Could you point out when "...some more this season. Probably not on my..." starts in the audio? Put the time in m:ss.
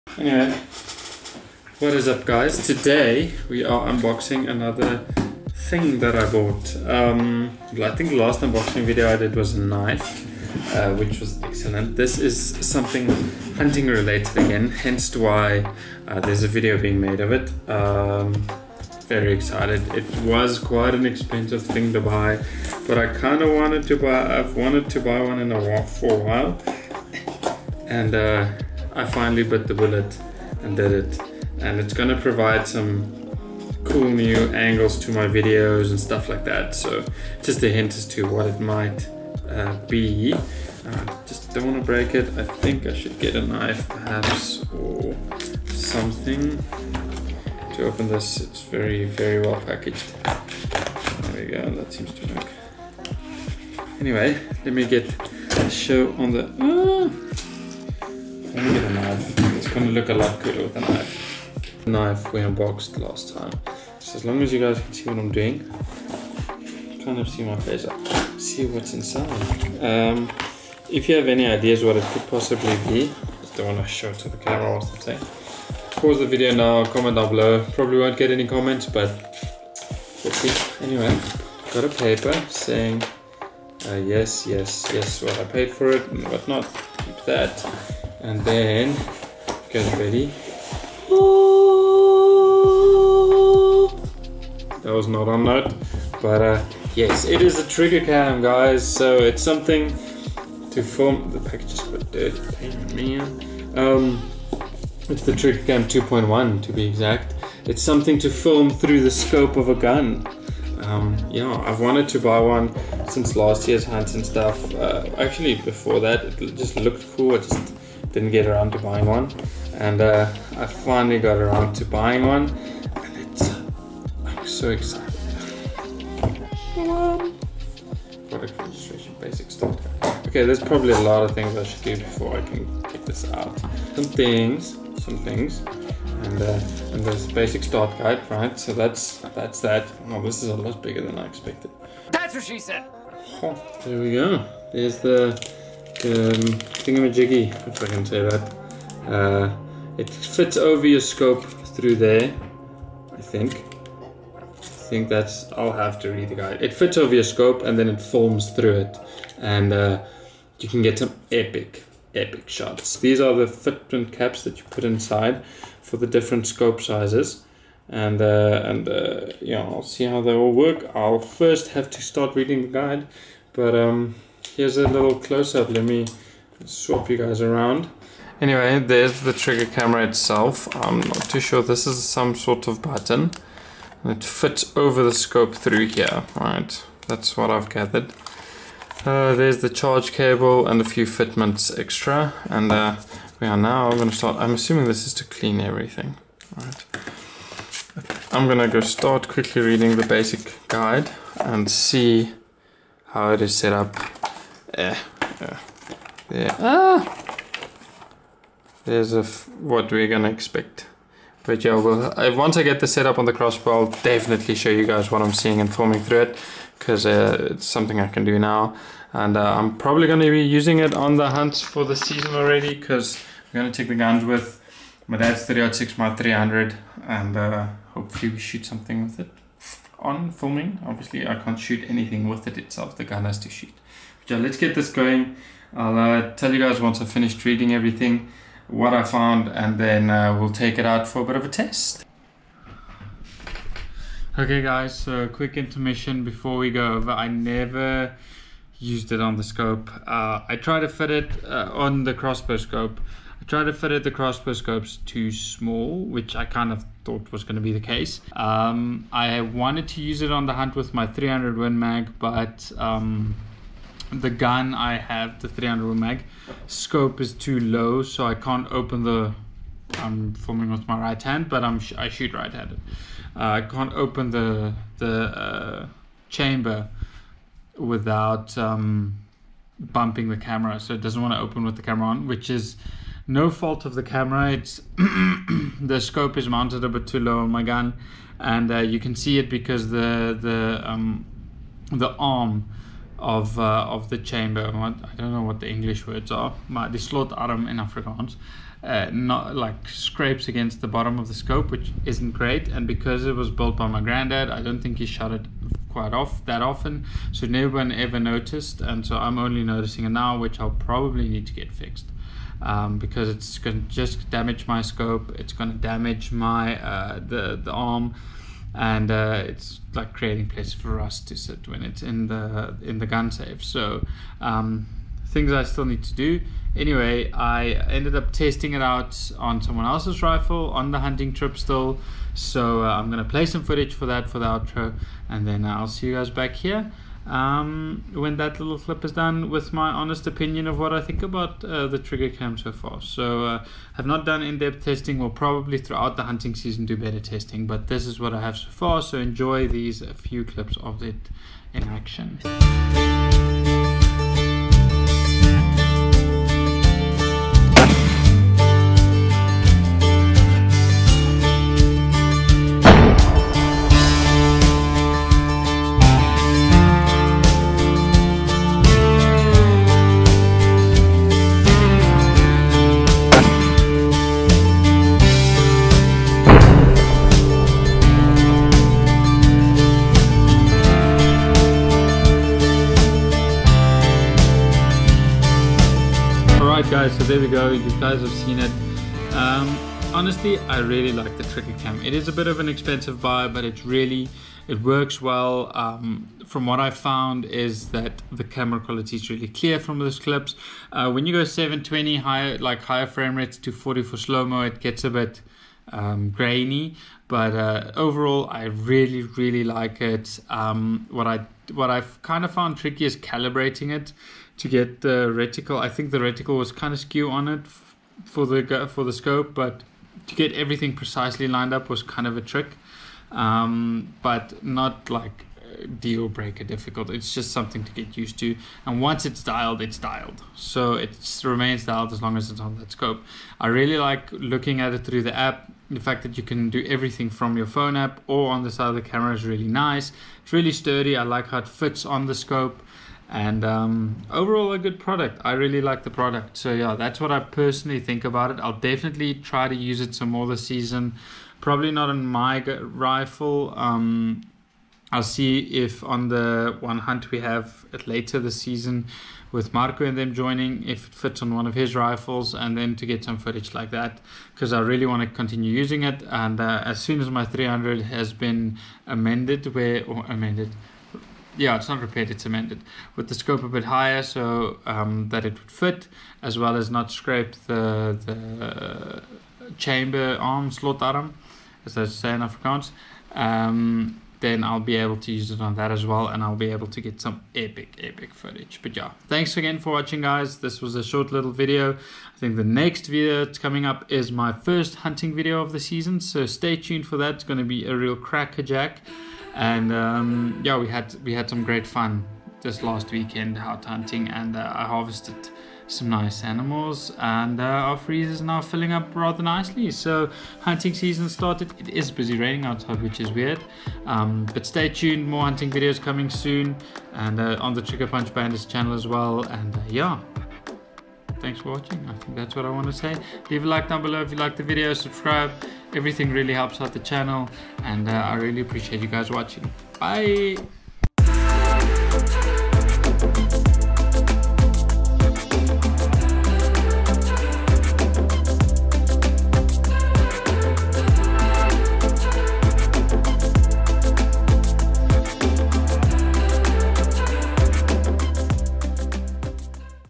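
7:30.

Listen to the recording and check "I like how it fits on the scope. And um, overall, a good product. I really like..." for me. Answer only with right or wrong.
right.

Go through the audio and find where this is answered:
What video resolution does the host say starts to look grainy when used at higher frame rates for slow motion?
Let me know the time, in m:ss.
6:41.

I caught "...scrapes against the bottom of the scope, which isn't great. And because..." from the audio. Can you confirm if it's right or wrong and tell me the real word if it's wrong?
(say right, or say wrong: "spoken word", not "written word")
right.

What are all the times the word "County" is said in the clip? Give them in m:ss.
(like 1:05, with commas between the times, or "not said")
not said.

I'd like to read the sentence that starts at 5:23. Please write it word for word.
So um, things I still need to do.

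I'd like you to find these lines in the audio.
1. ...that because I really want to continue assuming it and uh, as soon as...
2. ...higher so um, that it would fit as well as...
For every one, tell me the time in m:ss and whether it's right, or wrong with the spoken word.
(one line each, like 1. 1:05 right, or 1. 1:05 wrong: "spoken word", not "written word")
1. 7:43 wrong: "using", not "assuming"
2. 7:53 right.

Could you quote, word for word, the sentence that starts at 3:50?
Obviously, I can't shoot anything with it itself, the gun has to shoot yeah, let's get this going.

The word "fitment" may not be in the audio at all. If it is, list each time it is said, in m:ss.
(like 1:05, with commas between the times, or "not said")
2:43, 3:11.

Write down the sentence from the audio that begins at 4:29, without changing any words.
I'm filming with my right hand, but I'm I shoot right-handed.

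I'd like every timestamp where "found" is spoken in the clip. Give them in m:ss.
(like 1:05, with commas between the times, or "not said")
3:59, 6:36, 6:52.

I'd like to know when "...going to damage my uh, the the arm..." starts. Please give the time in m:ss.
5:15.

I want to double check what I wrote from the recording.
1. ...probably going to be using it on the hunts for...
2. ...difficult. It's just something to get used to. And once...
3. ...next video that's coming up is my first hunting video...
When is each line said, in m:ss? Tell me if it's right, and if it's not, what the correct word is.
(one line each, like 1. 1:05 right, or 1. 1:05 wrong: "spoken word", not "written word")
1. 3:39 right
2. 7:06 right
3. 8:12 right.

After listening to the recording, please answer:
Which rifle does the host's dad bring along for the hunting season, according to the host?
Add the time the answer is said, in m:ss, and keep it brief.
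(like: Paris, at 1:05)
306, at 3:45.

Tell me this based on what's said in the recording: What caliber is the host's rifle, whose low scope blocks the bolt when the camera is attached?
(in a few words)
300 Win Mag.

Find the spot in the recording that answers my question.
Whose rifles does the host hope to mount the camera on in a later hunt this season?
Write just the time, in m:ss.
7:39.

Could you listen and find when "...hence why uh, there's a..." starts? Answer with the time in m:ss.
0:14.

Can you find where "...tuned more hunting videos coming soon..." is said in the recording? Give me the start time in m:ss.
8:34.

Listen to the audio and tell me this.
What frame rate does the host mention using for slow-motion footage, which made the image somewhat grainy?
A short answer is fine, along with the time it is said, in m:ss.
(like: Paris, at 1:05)
40, at 6:43.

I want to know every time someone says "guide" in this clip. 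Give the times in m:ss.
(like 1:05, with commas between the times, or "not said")
2:17, 2:36, 2:52, 3:20.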